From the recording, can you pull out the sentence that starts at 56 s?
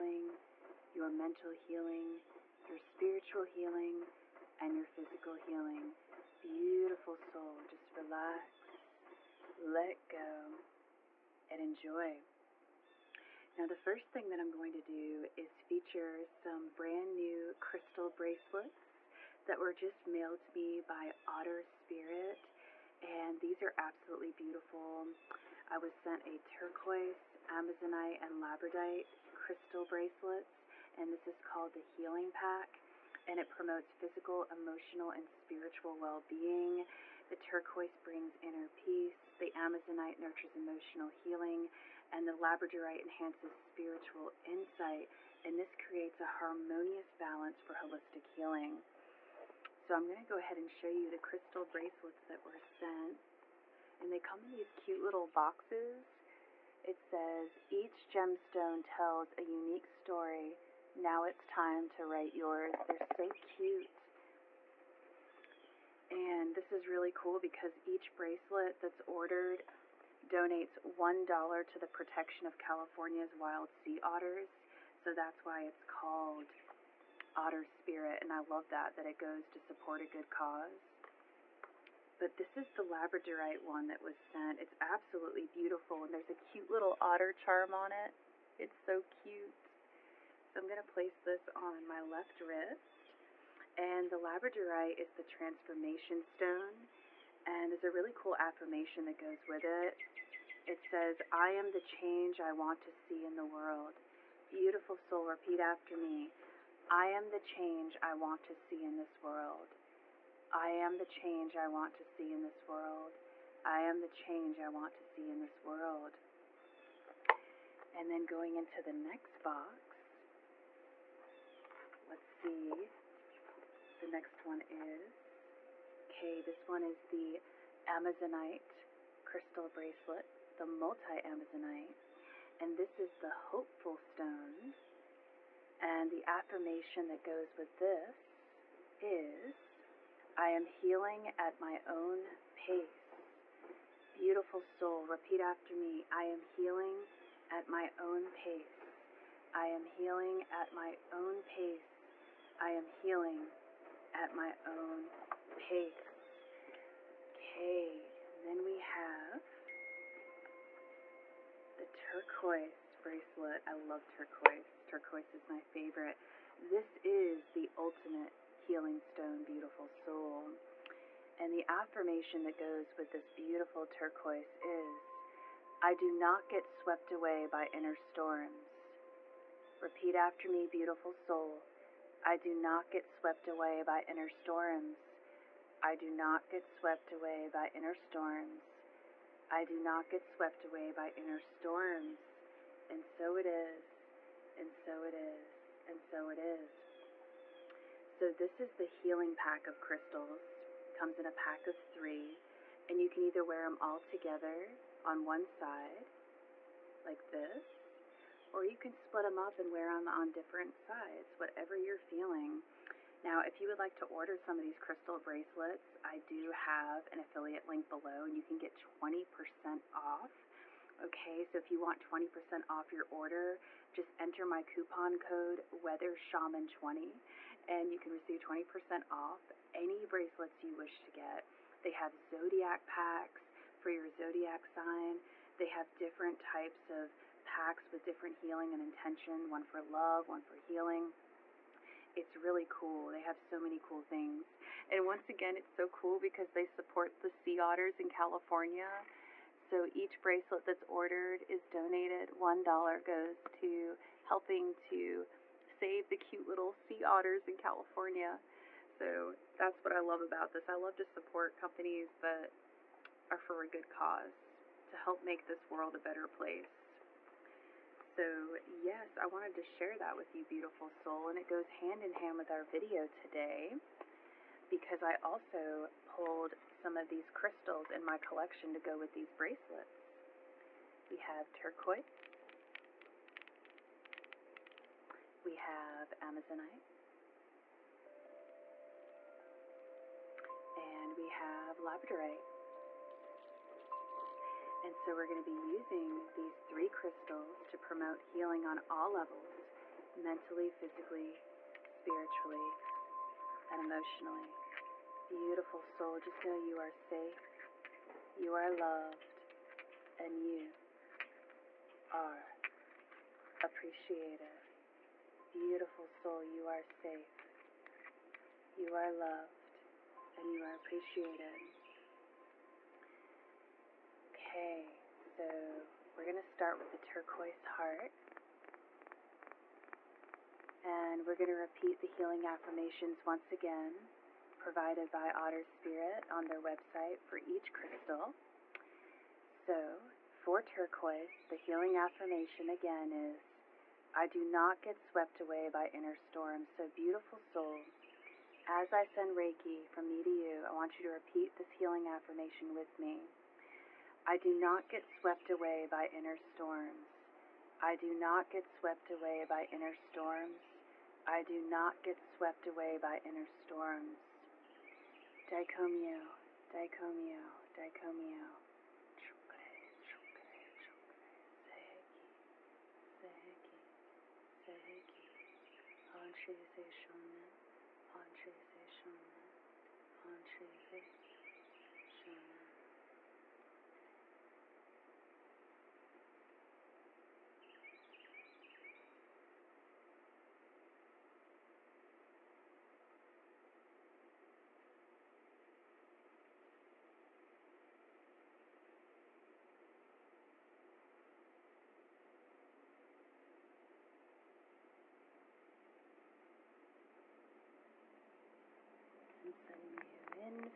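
It says, each gemstone tells a unique story.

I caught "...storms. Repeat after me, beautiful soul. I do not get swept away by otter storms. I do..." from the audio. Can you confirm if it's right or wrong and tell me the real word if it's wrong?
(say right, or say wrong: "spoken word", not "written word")
wrong: "inner", not "otter".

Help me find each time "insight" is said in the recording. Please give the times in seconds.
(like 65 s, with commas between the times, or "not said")
44 s.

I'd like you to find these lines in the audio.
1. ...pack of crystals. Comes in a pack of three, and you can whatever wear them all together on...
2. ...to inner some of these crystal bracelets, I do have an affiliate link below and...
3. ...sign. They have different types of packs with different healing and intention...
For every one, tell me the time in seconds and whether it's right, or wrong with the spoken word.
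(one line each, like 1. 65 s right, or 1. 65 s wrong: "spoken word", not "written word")
1. 199 s wrong: "either", not "whatever"
2. 213 s wrong: "order", not "inner"
3. 234 s right.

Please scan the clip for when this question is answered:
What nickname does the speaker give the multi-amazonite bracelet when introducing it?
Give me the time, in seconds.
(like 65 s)
133 s.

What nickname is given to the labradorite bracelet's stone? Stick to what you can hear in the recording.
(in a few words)
transformation stone.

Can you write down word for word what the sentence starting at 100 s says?
It says, I am the change I want to see in the world.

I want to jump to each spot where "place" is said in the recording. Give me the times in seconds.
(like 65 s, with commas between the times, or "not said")
90 s, 266 s.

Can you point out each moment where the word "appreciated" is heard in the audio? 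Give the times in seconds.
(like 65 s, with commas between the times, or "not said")
313 s, 320 s.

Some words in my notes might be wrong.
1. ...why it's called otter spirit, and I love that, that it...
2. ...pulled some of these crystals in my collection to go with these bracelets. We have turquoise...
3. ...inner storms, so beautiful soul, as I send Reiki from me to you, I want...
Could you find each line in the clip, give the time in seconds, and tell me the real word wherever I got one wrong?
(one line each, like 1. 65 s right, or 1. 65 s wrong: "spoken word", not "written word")
1. 75 s right
2. 276 s right
3. 345 s right.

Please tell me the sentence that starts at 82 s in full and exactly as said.
But this is the Labradorite one that was sent.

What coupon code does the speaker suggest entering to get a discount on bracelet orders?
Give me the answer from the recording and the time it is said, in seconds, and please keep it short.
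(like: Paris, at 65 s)
WeatherShaman20, at 225 s.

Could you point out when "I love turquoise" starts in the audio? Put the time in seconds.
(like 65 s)
163 s.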